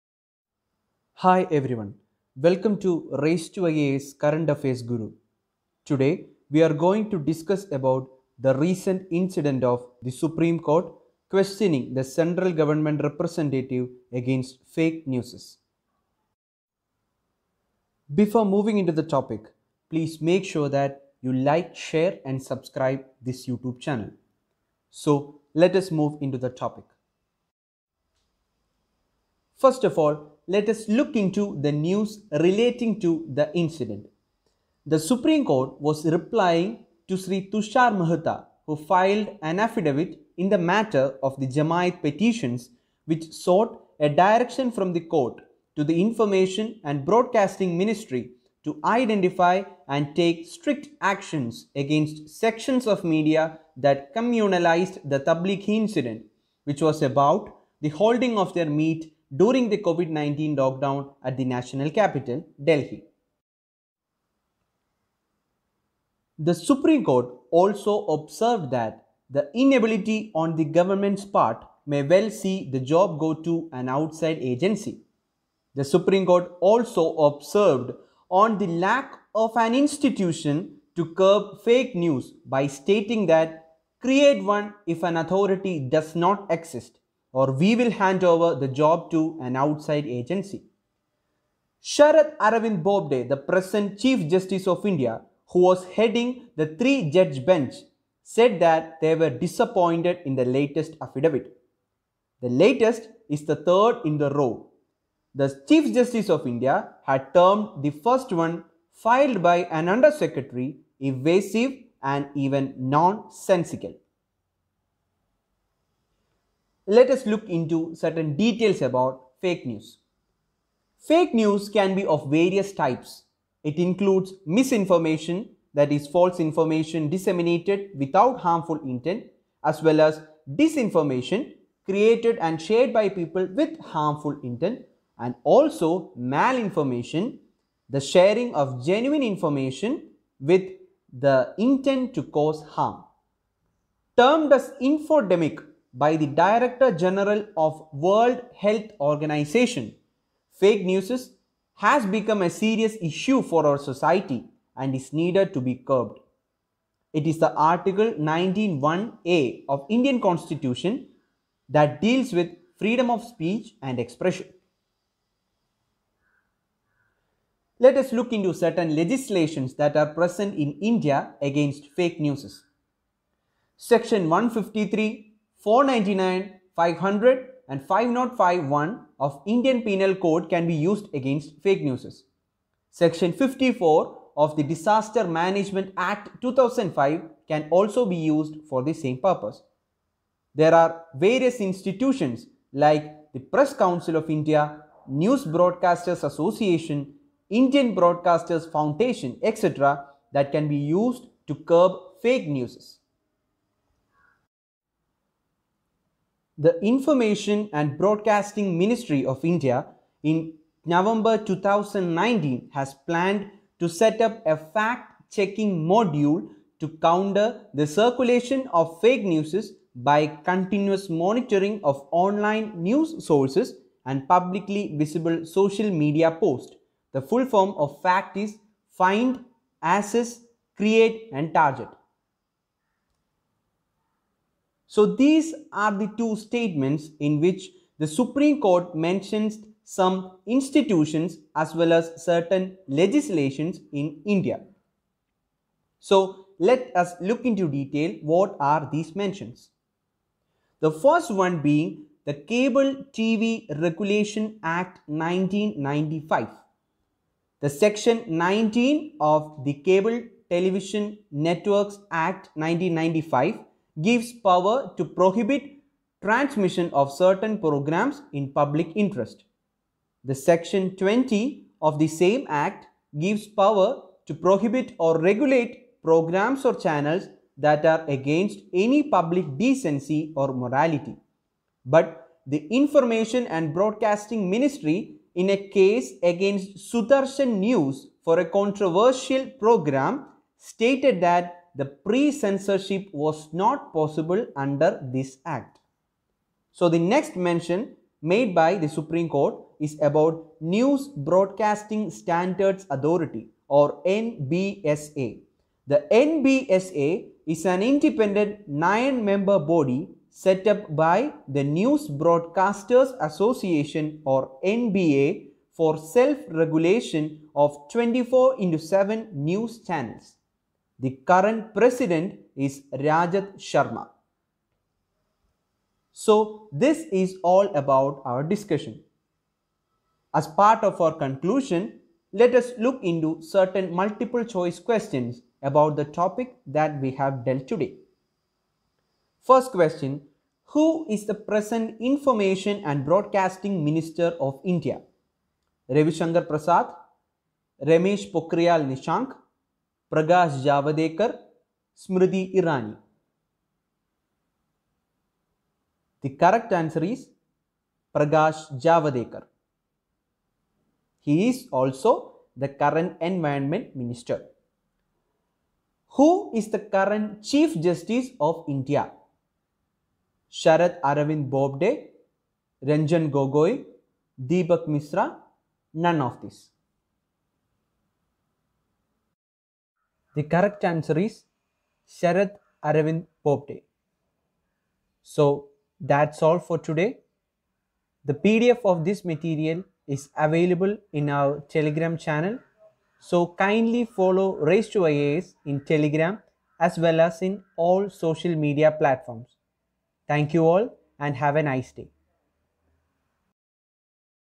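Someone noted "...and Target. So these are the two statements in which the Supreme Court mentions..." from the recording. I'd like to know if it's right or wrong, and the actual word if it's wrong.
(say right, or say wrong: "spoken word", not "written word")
right.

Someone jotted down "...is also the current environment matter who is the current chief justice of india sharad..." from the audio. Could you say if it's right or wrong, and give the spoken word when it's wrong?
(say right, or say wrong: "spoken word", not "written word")
wrong: "minister", not "matter".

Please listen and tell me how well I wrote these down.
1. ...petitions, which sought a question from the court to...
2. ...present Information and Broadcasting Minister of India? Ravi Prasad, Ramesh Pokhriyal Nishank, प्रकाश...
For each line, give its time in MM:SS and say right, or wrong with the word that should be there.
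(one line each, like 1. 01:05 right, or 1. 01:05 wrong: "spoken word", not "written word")
1. 00:42 wrong: "direction", not "question"
2. 05:41 right.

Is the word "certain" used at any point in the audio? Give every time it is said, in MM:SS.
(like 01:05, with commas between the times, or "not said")
01:57, 02:48, 04:02, 04:27, 05:33.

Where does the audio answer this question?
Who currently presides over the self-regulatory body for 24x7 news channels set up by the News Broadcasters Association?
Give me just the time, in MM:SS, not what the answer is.
05:22.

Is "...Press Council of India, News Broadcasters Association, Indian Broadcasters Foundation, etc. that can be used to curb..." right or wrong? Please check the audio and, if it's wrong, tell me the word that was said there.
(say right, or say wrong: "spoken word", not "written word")
right.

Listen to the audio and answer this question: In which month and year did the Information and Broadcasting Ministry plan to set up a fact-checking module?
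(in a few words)
November 2019.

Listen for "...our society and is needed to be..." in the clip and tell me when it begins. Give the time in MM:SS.
02:33.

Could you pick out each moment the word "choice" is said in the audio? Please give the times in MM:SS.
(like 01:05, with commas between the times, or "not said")
05:34.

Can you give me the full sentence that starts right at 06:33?
So kindly follow Race to IAS in Telegram as well as in all social media platforms.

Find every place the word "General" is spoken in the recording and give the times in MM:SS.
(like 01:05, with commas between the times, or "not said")
02:26.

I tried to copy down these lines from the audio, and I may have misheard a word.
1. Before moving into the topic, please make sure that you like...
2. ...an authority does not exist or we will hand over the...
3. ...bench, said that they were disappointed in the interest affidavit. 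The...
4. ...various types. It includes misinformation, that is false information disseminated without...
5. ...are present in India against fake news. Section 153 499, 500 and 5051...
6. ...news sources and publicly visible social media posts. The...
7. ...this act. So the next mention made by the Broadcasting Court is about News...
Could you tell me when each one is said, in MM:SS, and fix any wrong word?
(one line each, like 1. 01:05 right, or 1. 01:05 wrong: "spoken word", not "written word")
1. 00:18 right
2. 01:25 right
3. 01:37 wrong: "latest", not "interest"
4. 02:02 right
5. 02:49 right
6. 03:42 right
7. 04:55 wrong: "Supreme", not "Broadcasting".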